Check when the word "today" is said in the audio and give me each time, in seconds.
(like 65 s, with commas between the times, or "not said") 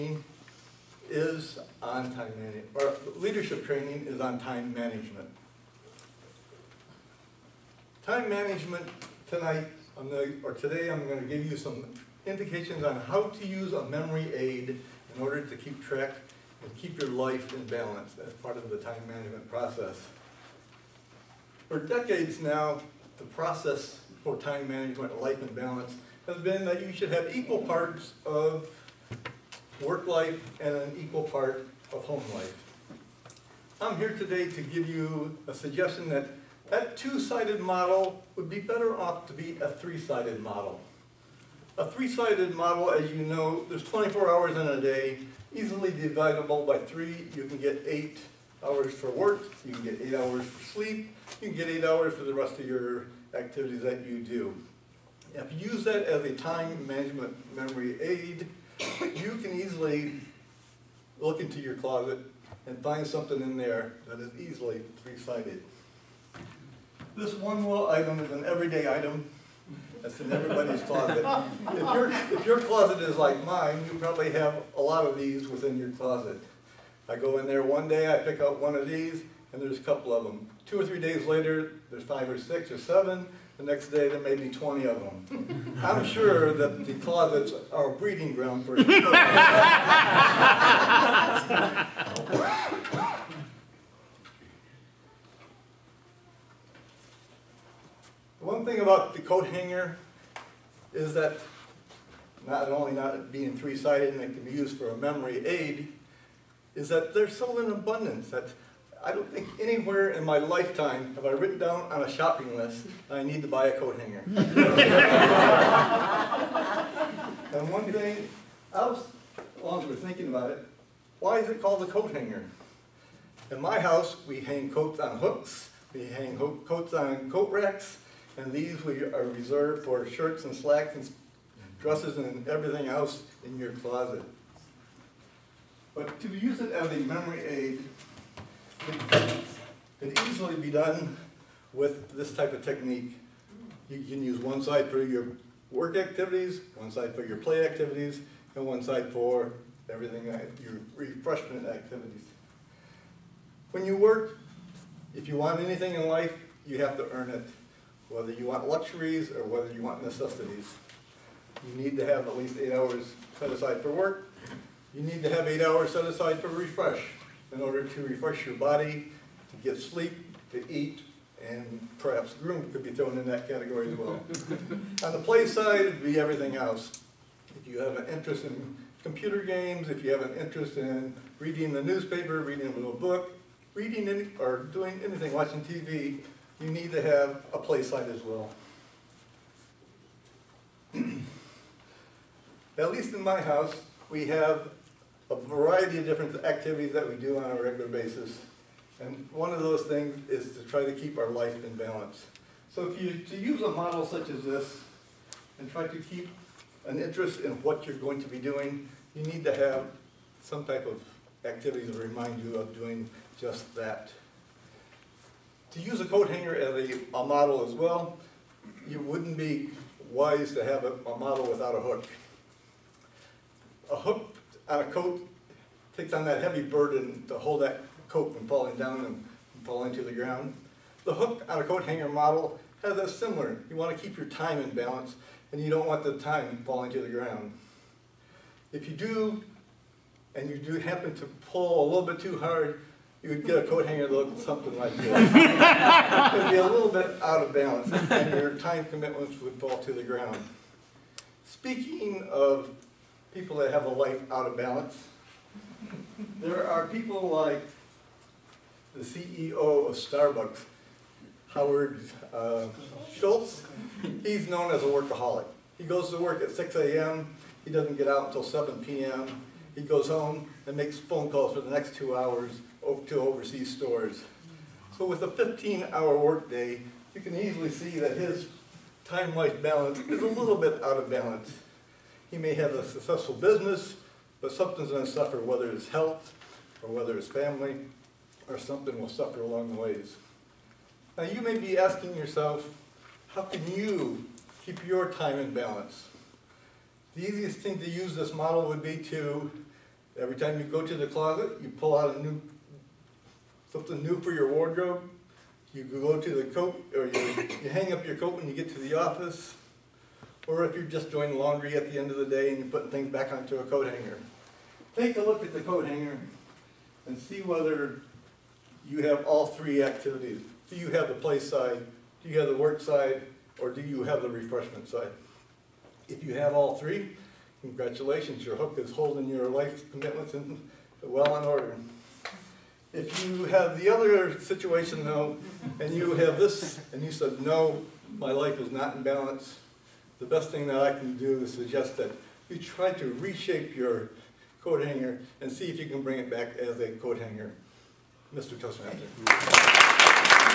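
10 s, 34 s.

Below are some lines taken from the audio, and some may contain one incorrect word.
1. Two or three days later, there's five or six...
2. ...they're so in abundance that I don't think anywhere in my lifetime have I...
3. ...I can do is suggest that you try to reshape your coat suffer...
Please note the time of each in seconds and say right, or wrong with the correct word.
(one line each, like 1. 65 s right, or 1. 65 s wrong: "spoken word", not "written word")
1. 80 s right
2. 107 s right
3. 340 s wrong: "hanger", not "suffer".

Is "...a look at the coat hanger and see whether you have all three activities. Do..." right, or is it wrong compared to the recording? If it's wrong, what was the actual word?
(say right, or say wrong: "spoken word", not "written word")
right.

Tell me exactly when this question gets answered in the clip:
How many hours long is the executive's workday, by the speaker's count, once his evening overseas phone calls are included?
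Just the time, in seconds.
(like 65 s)
275 s.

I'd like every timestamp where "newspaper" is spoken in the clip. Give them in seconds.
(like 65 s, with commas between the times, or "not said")
181 s.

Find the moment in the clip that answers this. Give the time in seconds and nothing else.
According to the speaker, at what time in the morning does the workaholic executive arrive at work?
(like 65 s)
266 s.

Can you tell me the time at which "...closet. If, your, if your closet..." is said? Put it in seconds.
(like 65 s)
70 s.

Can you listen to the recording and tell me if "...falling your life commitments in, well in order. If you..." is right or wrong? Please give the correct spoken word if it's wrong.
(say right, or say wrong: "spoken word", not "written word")
wrong: "holding", not "falling".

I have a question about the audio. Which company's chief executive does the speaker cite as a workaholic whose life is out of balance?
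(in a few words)
Starbucks.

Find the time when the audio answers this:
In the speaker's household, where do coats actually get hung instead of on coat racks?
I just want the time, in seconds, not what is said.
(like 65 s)
125 s.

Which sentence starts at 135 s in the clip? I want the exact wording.
But to use it as a memory aid could easily be done with this type of technique.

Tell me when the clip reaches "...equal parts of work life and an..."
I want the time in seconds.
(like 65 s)
27 s.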